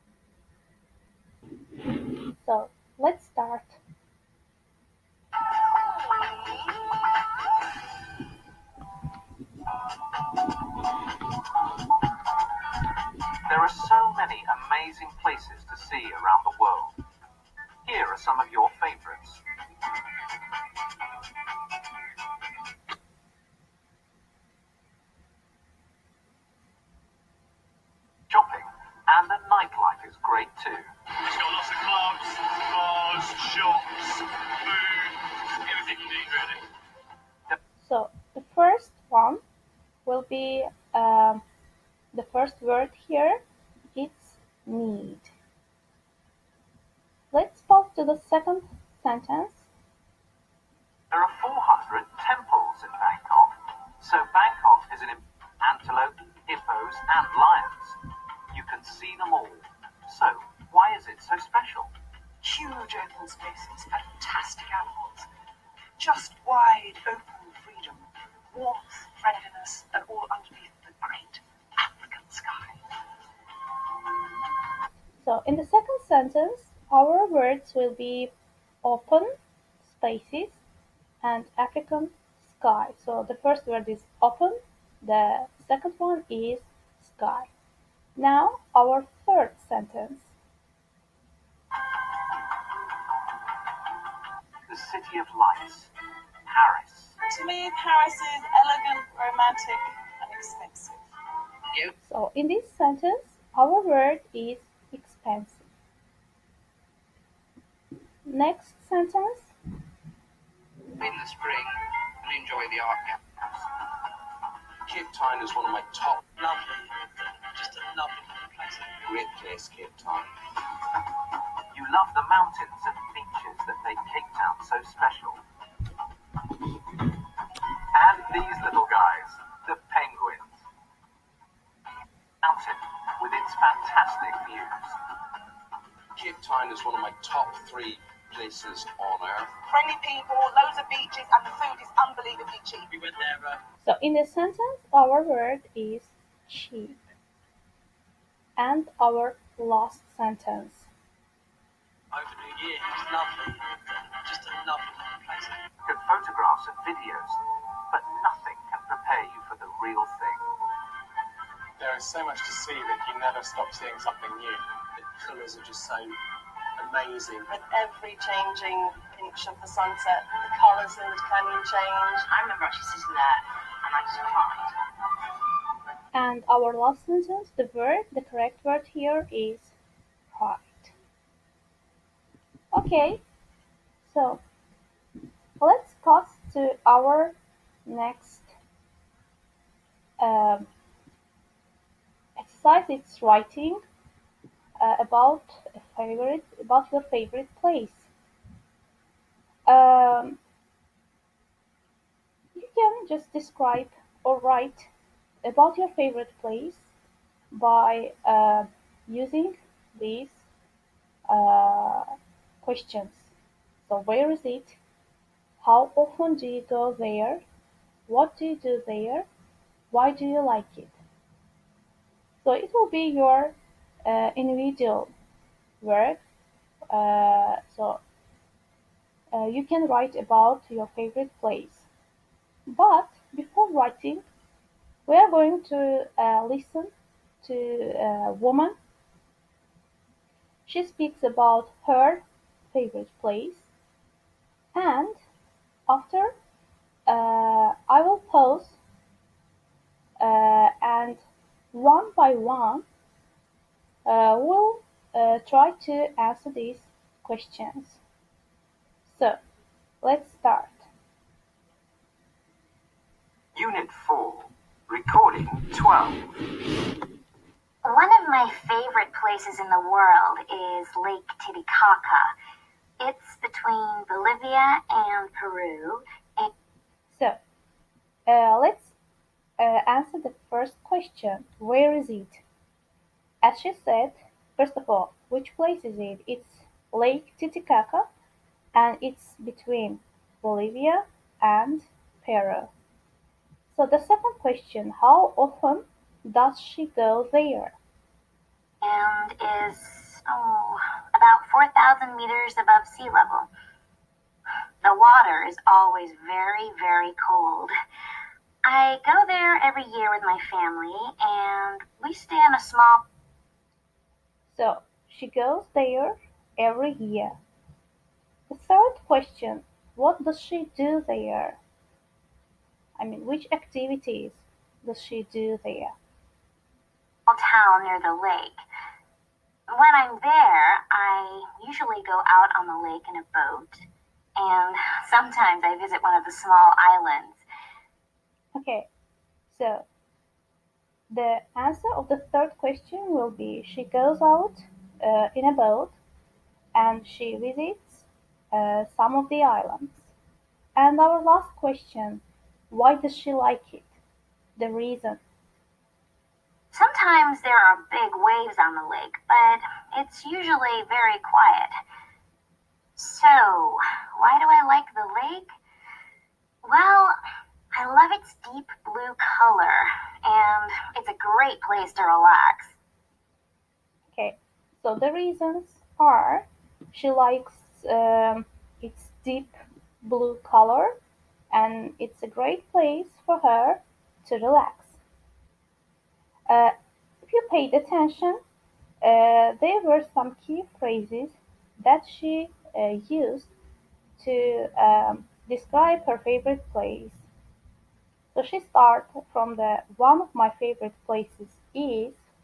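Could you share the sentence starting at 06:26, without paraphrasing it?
Uh, if you paid attention, uh, there were some key phrases that she uh, used to um, describe her favorite place.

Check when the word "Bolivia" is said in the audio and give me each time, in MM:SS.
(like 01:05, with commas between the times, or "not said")
04:34, 04:50.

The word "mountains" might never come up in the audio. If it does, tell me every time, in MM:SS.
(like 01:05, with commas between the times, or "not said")
02:02, 02:12.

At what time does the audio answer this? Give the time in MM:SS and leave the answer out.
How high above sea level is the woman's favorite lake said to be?
05:01.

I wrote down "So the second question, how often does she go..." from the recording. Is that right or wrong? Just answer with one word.
right.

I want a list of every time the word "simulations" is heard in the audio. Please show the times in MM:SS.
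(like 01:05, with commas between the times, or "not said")
not said.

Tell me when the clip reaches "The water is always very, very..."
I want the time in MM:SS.
05:04.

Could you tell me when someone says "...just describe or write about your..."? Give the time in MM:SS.
03:23.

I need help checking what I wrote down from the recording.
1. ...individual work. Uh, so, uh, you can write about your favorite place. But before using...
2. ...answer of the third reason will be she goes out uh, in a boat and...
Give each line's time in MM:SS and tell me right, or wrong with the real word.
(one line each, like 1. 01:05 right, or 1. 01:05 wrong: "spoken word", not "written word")
1. 03:44 wrong: "writing", not "using"
2. 05:41 wrong: "question", not "reason".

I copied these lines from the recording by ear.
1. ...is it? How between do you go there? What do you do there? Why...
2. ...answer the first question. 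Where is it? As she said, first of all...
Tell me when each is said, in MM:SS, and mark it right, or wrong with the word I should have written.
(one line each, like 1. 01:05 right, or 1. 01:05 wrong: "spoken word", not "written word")
1. 03:34 wrong: "often", not "between"
2. 04:39 right.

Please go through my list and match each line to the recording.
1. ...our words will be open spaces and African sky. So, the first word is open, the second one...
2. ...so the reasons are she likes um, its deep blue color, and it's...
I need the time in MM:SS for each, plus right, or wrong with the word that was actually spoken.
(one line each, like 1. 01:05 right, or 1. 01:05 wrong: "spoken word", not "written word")
1. 01:16 right
2. 06:14 right.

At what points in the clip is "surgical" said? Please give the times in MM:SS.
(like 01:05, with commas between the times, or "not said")
not said.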